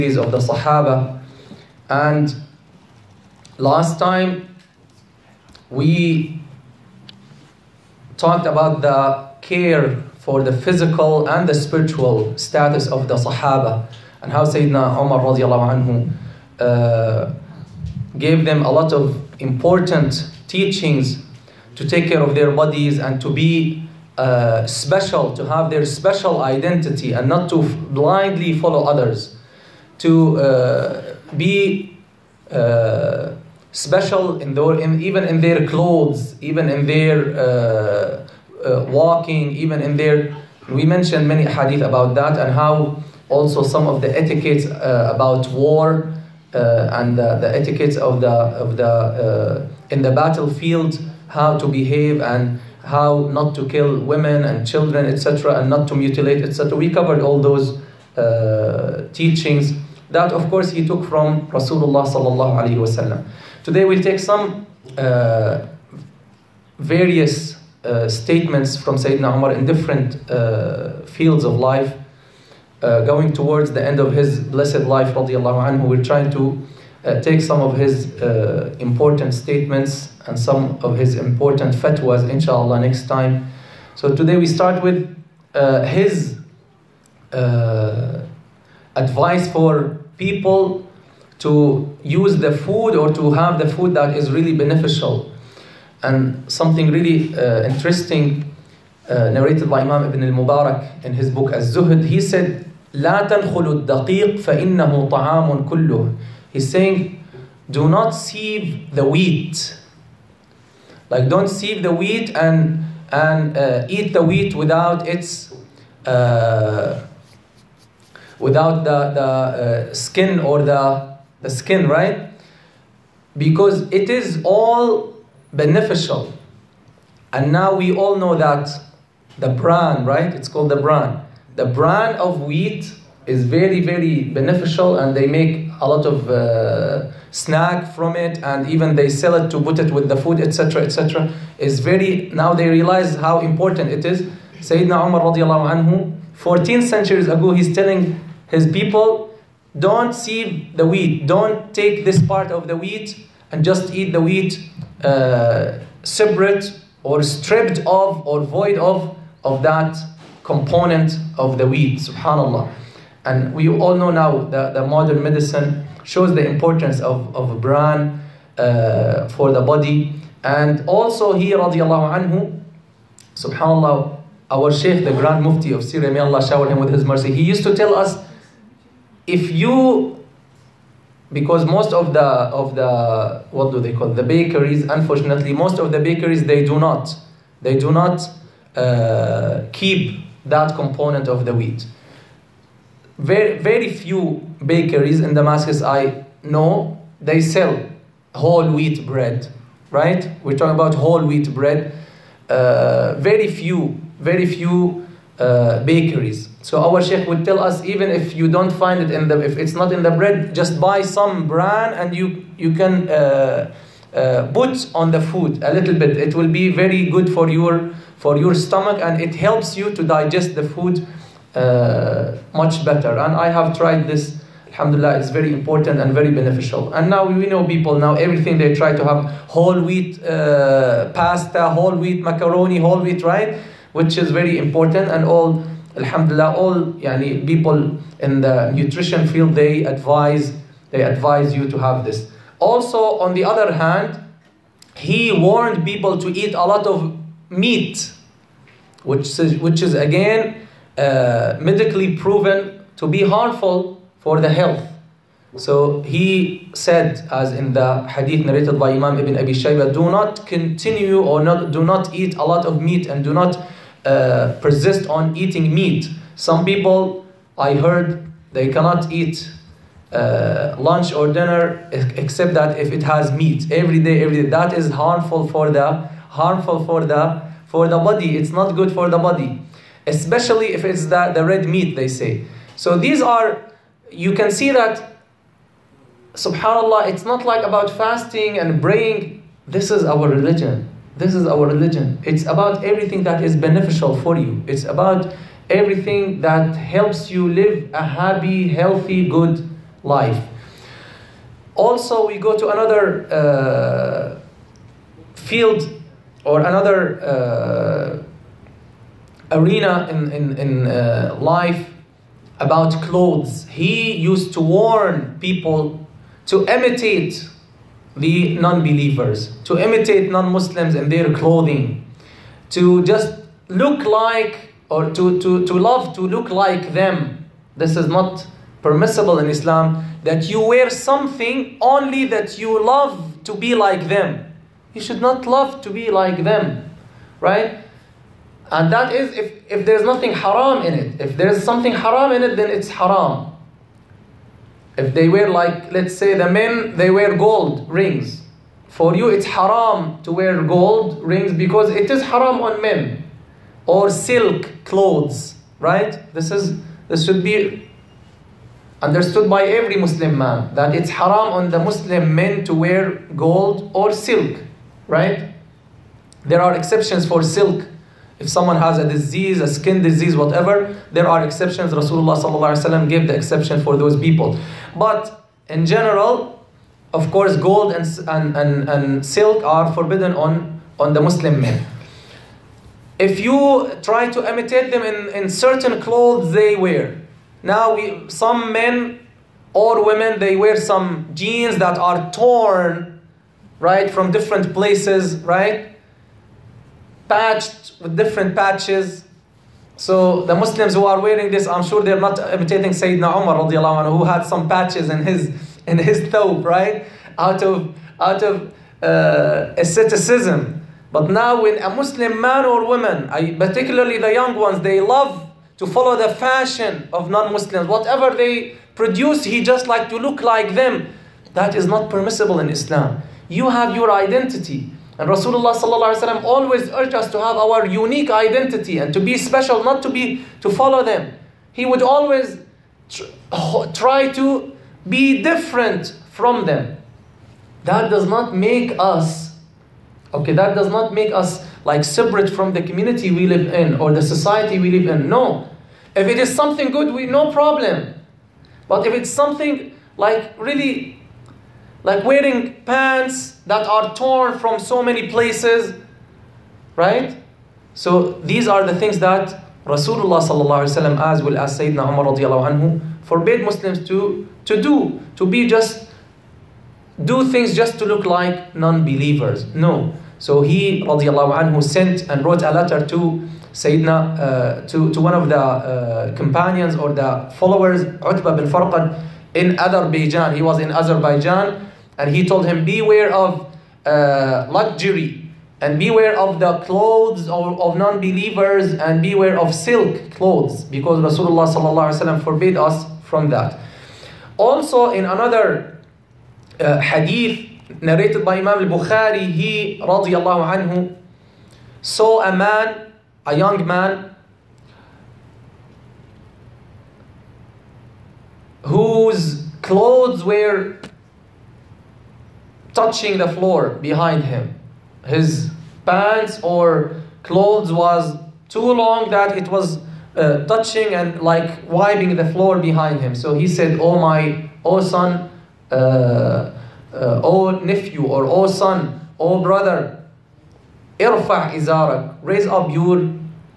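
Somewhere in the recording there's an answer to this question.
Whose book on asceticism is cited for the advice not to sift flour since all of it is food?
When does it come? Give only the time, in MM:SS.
01:40.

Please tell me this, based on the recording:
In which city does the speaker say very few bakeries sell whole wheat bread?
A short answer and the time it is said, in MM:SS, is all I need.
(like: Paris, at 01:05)
Damascus, at 03:15.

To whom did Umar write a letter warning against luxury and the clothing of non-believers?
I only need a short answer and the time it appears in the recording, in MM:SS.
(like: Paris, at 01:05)
Utbah bin Farqad, at 07:58.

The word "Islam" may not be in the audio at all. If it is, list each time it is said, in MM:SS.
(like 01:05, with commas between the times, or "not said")
05:29, 07:02.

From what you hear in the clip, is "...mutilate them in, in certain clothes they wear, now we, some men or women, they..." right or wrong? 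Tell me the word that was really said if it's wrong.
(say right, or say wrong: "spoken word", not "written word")
wrong: "imitate", not "mutilate".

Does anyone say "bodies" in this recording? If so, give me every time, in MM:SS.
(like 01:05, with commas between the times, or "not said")
00:22.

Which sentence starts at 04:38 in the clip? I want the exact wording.
It's not good for the body, especially if it's the, the red meat.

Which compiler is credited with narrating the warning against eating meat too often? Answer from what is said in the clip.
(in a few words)
Ibn Abi Shaybah.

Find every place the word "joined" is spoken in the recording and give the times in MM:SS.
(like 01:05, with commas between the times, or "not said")
not said.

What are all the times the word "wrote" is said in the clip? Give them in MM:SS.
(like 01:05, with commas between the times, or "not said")
07:52.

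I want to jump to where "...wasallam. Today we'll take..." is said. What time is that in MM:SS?
01:02.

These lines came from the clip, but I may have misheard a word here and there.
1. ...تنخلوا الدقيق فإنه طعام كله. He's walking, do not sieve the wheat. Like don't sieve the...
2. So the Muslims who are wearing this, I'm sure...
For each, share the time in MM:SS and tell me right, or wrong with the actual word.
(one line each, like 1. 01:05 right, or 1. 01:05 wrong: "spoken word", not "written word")
1. 01:43 wrong: "saying", not "walking"
2. 06:39 right.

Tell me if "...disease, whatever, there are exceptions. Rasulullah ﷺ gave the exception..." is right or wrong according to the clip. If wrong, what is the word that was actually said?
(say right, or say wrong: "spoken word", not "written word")
right.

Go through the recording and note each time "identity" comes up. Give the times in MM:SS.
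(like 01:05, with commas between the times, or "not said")
00:26, 07:04, 07:08.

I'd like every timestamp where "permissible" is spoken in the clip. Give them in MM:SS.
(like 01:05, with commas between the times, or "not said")
05:28, 07:02.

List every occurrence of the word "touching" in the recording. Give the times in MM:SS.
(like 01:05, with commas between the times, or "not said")
08:32, 08:40.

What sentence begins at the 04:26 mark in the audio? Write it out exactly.
Some people, I heard, they cannot eat uh, lunch or dinner except that if it has meat every day, every day.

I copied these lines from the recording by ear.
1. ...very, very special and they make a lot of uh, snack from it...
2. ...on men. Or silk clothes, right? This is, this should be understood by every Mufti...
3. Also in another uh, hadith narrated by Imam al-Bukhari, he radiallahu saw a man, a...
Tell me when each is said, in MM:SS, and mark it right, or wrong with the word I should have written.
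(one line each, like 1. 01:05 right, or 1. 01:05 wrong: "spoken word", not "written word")
1. 02:13 wrong: "beneficial", not "special"
2. 05:52 wrong: "Muslim", not "Mufti"
3. 08:14 right.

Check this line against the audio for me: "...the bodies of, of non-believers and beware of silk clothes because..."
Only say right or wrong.
wrong.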